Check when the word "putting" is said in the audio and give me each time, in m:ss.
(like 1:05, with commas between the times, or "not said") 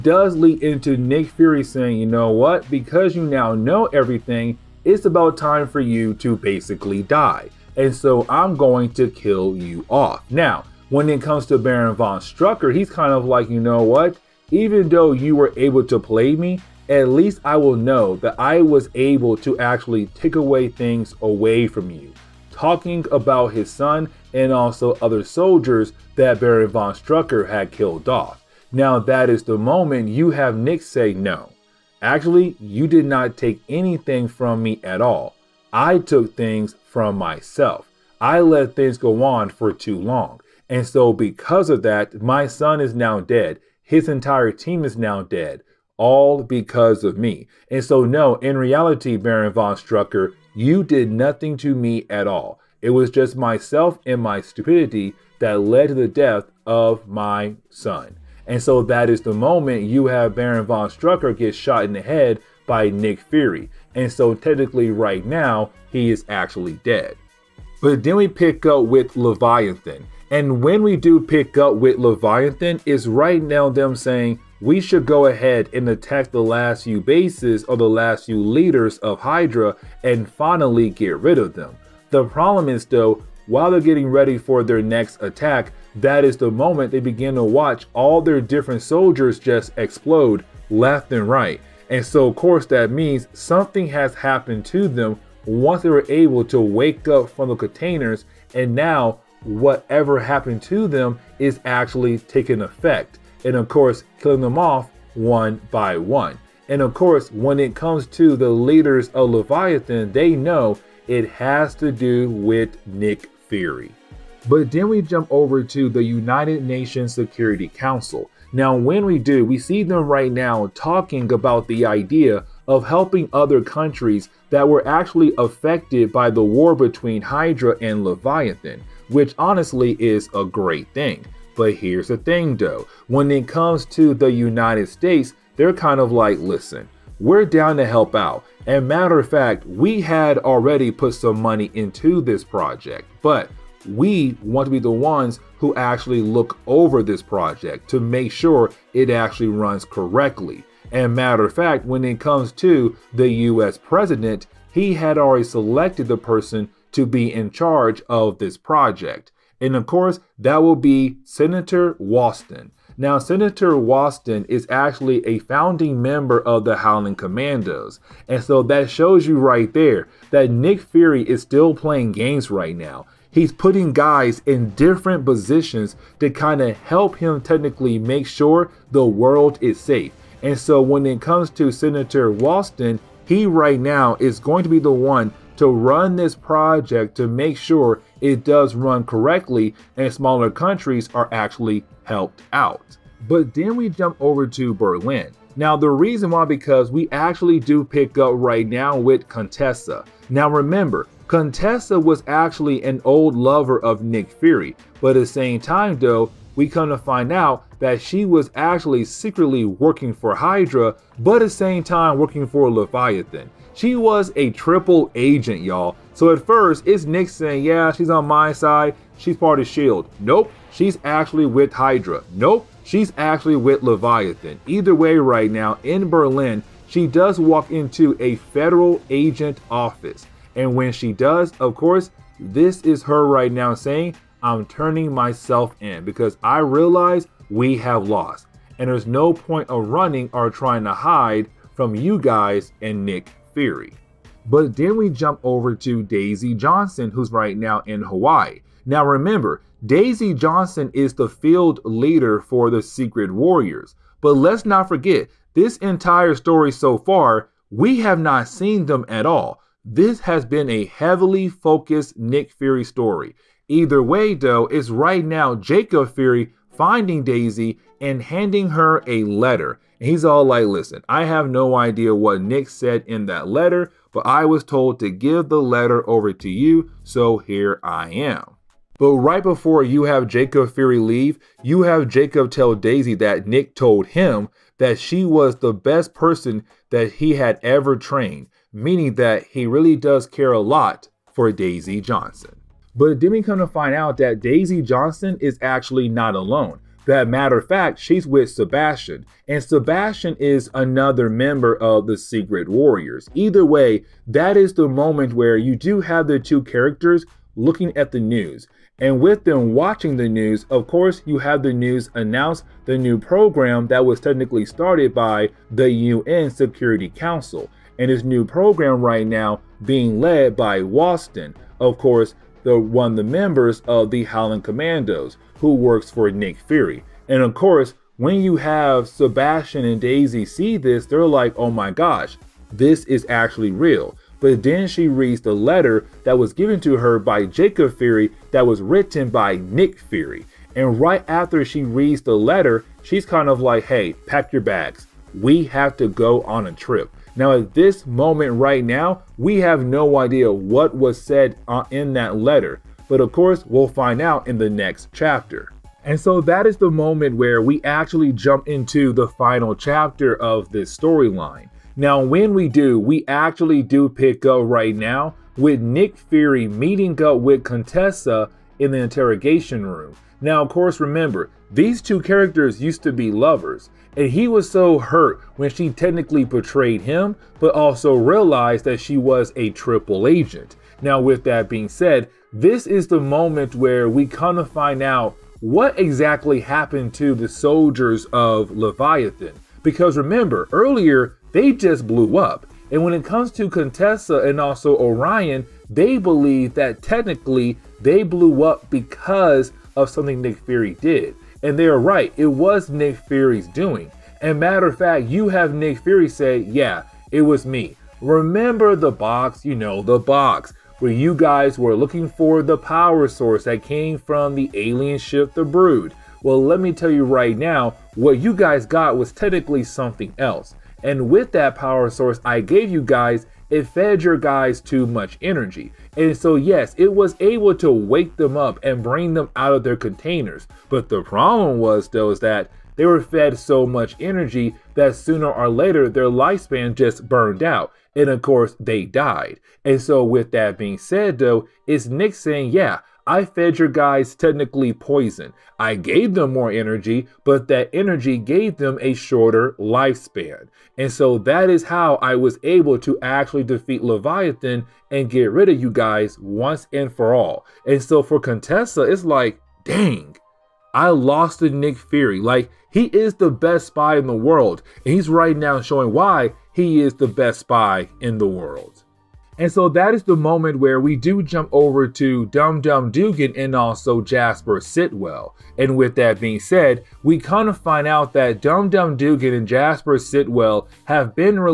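2:53.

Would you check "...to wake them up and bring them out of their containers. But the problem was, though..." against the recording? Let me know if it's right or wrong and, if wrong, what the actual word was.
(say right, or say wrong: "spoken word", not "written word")
right.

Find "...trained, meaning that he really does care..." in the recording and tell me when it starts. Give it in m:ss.
4:47.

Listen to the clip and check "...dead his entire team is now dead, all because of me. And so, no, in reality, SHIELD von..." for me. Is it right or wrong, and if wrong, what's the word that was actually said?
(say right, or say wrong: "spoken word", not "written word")
wrong: "Baron", not "SHIELD".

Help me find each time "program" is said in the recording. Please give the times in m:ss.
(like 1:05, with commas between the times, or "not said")
5:13, 5:18.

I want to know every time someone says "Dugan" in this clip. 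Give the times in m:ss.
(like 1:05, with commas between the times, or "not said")
7:53, 7:59.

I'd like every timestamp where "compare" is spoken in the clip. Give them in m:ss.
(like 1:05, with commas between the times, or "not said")
not said.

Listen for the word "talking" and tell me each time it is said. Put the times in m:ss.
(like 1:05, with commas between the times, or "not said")
0:22, 2:00.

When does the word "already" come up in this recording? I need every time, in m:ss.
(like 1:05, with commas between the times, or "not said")
2:20, 2:35.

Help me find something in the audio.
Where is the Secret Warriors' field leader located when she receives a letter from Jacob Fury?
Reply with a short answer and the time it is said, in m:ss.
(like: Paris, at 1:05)
Hawaii, at 4:08.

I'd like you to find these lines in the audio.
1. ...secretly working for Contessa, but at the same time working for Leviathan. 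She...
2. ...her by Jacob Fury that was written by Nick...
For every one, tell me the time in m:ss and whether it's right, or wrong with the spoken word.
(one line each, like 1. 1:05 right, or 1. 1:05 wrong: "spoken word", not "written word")
1. 3:29 wrong: "Hydra", not "Contessa"
2. 5:36 right.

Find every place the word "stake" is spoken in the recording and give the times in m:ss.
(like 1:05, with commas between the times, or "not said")
not said.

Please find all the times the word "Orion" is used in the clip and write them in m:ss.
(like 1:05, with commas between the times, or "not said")
6:34.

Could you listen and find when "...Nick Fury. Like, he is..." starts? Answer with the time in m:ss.
7:41.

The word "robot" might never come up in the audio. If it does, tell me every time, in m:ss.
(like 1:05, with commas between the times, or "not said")
not said.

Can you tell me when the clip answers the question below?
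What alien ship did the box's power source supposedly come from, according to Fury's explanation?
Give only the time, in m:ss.
6:55.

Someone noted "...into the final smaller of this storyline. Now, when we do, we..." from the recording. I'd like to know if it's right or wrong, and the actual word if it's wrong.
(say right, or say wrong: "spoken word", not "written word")
wrong: "chapter", not "smaller".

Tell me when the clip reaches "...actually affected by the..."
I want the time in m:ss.
2:04.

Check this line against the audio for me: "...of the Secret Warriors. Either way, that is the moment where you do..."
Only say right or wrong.
right.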